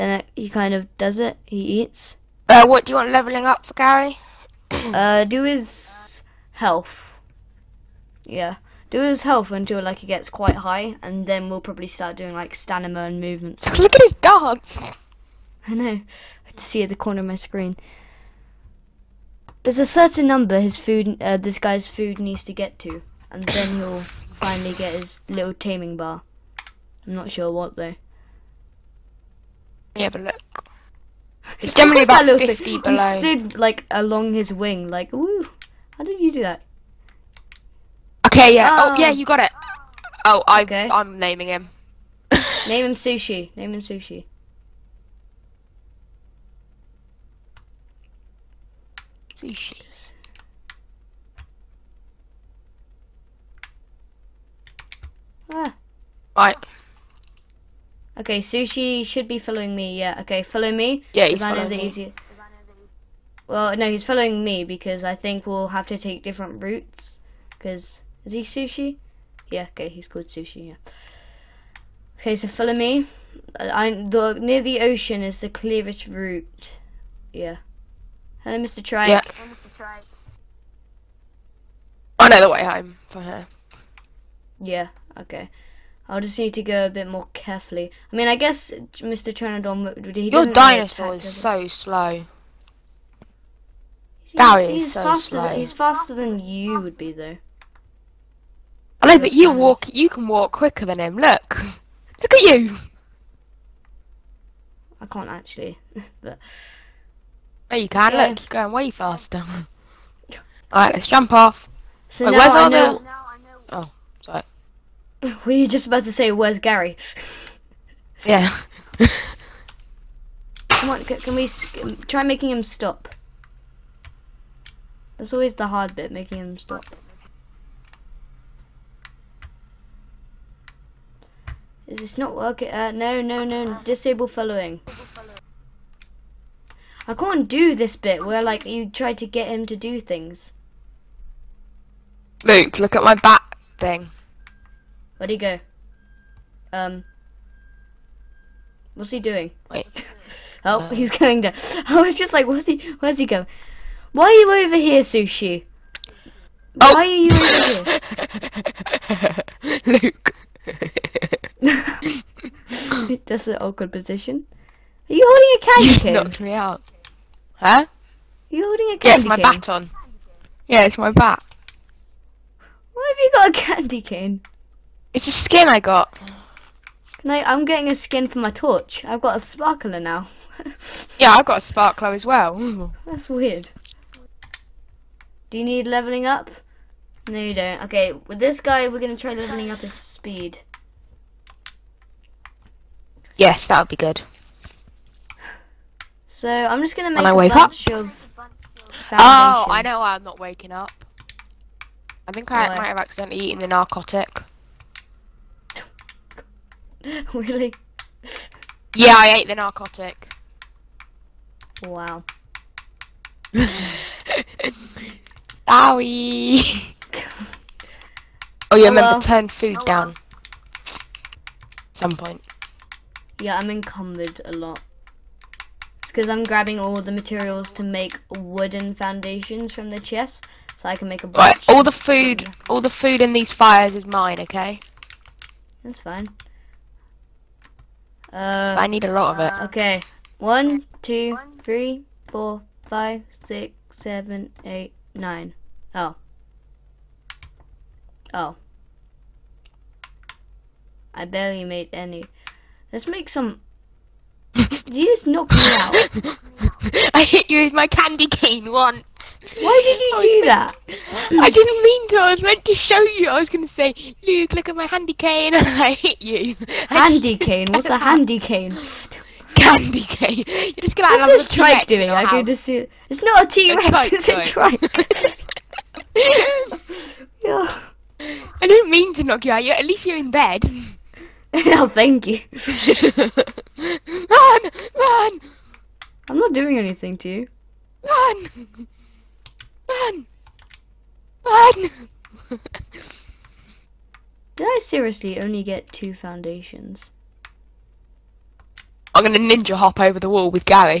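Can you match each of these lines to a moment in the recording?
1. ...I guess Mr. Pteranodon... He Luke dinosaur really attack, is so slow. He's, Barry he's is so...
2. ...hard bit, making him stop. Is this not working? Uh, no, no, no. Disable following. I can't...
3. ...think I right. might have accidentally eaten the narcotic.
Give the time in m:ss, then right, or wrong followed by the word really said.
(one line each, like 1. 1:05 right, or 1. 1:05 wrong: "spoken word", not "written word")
1. 1:28 wrong: "Your", not "Luke"
2. 2:05 right
3. 3:22 right.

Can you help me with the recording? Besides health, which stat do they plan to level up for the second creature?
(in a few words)
Speed.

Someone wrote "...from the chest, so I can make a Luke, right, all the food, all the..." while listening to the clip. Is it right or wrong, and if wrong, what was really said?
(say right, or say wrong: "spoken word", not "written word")
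wrong: "All", not "Luke".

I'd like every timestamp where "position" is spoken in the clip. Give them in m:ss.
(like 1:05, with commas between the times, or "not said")
2:43.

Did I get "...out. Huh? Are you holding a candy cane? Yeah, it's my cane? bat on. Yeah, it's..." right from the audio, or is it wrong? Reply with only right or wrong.
right.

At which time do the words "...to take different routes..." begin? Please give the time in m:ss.
1:05.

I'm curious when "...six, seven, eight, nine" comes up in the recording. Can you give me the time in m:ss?
4:03.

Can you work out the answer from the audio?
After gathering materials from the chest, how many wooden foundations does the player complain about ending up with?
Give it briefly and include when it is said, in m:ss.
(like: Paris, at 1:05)
2, at 4:55.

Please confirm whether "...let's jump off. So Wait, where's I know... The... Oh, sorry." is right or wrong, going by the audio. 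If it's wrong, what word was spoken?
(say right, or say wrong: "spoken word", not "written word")
right.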